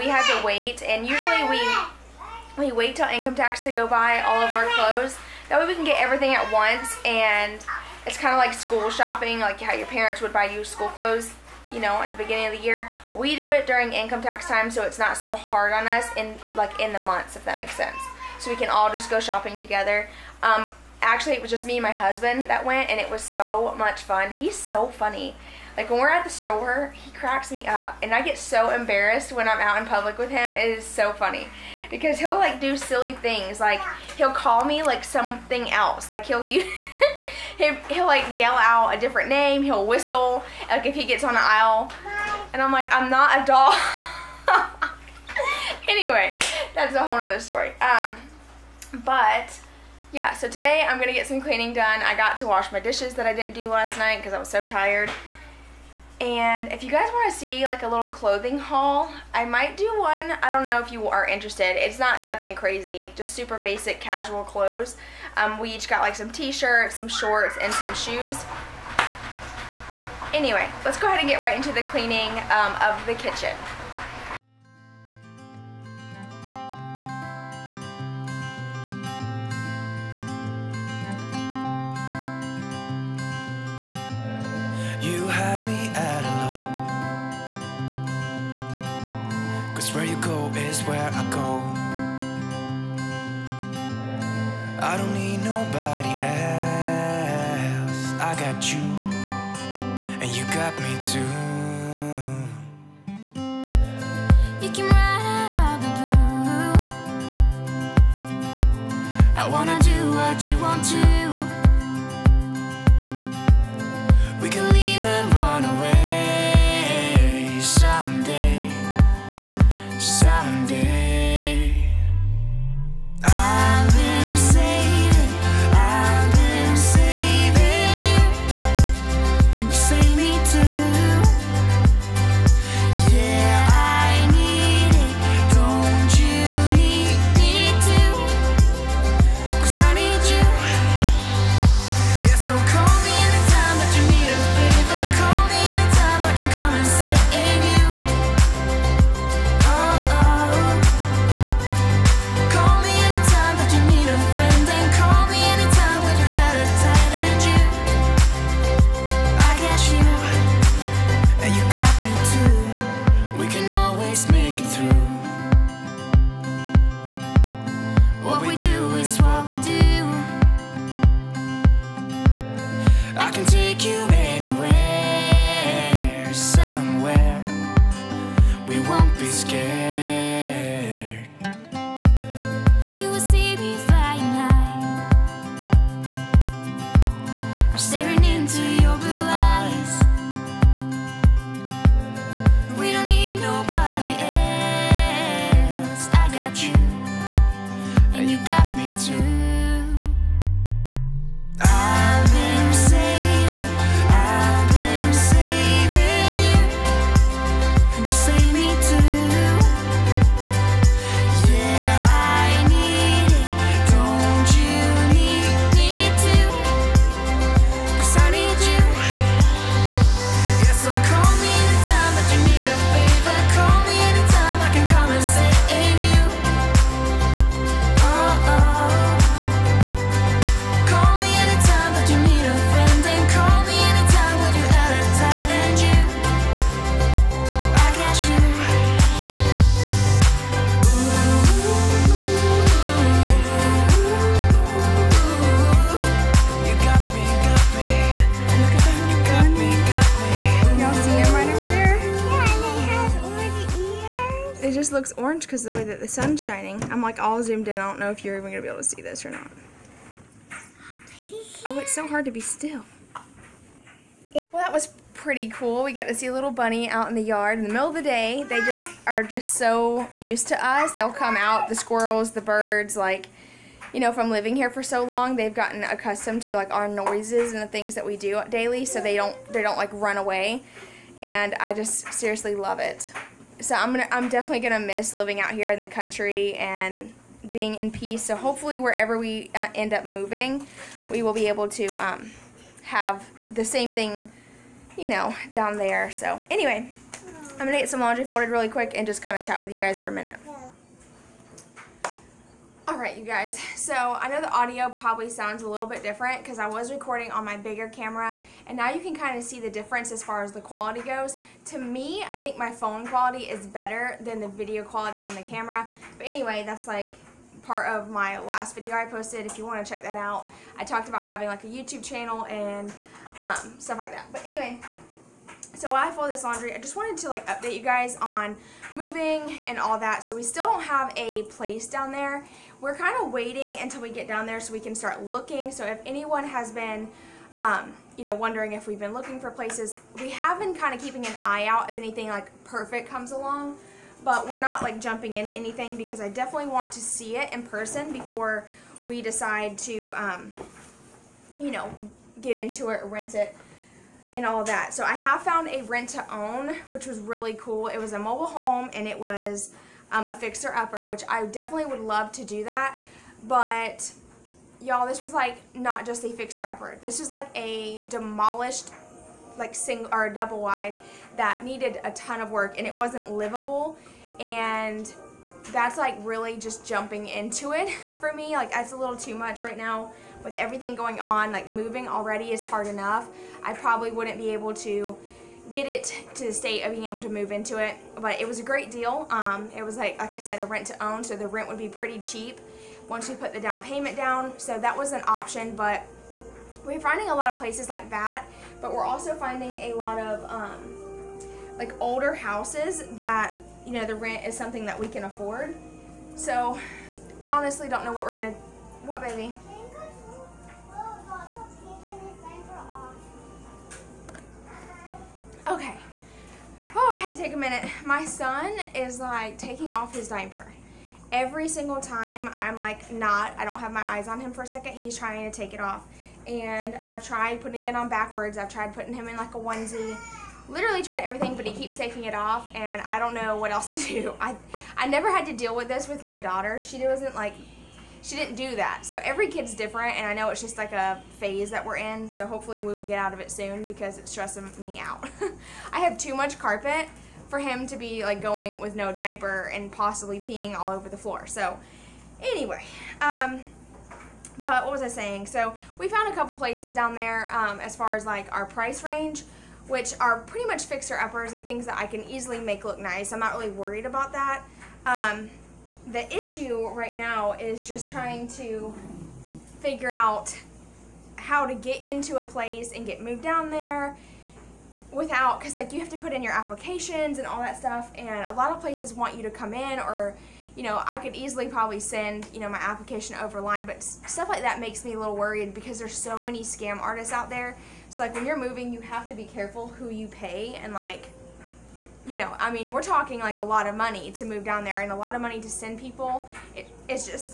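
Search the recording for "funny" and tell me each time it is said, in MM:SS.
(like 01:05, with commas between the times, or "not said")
00:24, 00:31.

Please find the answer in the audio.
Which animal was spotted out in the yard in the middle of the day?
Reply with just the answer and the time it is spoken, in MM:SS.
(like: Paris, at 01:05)
bunny, at 04:26.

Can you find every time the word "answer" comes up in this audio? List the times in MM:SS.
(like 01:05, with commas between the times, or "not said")
not said.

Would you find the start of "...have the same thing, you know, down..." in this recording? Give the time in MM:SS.
04:52.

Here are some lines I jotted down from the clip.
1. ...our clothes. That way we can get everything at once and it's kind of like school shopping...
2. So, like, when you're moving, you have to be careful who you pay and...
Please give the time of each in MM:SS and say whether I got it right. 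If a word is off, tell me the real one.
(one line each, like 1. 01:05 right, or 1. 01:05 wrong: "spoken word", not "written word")
1. 00:04 right
2. 08:08 right.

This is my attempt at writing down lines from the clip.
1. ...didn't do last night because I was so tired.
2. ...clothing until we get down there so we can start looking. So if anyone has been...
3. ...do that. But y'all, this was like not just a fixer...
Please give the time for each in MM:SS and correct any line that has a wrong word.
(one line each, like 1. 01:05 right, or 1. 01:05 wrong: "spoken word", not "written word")
1. 00:53 right
2. 05:33 wrong: "waiting", not "clothing"
3. 06:02 right.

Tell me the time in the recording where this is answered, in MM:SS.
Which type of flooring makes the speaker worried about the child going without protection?
07:26.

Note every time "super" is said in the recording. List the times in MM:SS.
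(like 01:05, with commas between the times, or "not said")
01:03.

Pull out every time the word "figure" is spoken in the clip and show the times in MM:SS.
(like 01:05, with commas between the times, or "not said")
07:49.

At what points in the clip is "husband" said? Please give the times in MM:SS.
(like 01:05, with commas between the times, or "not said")
00:21.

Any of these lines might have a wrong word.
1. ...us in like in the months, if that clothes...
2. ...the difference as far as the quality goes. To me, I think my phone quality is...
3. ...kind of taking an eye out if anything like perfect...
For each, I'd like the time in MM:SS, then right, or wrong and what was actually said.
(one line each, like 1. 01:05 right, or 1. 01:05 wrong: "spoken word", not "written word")
1. 00:15 wrong: "makes", not "clothes"
2. 05:09 right
3. 05:40 wrong: "keeping", not "taking".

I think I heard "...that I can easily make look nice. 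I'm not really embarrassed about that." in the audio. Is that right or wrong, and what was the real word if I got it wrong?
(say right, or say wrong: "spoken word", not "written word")
wrong: "worried", not "embarrassed".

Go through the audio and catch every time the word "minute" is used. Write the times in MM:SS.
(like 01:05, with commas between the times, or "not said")
05:00, 06:57.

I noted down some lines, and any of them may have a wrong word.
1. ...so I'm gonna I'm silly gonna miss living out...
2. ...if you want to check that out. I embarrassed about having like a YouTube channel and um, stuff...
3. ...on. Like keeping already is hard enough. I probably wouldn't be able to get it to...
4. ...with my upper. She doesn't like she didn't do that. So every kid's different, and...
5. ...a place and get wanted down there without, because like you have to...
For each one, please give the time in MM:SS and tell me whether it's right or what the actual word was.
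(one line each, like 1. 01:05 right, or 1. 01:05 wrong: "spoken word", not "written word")
1. 04:43 wrong: "definitely", not "silly"
2. 05:19 wrong: "talked", not "embarrassed"
3. 06:21 wrong: "moving", not "keeping"
4. 07:16 wrong: "daughter", not "upper"
5. 07:52 wrong: "moved", not "wanted".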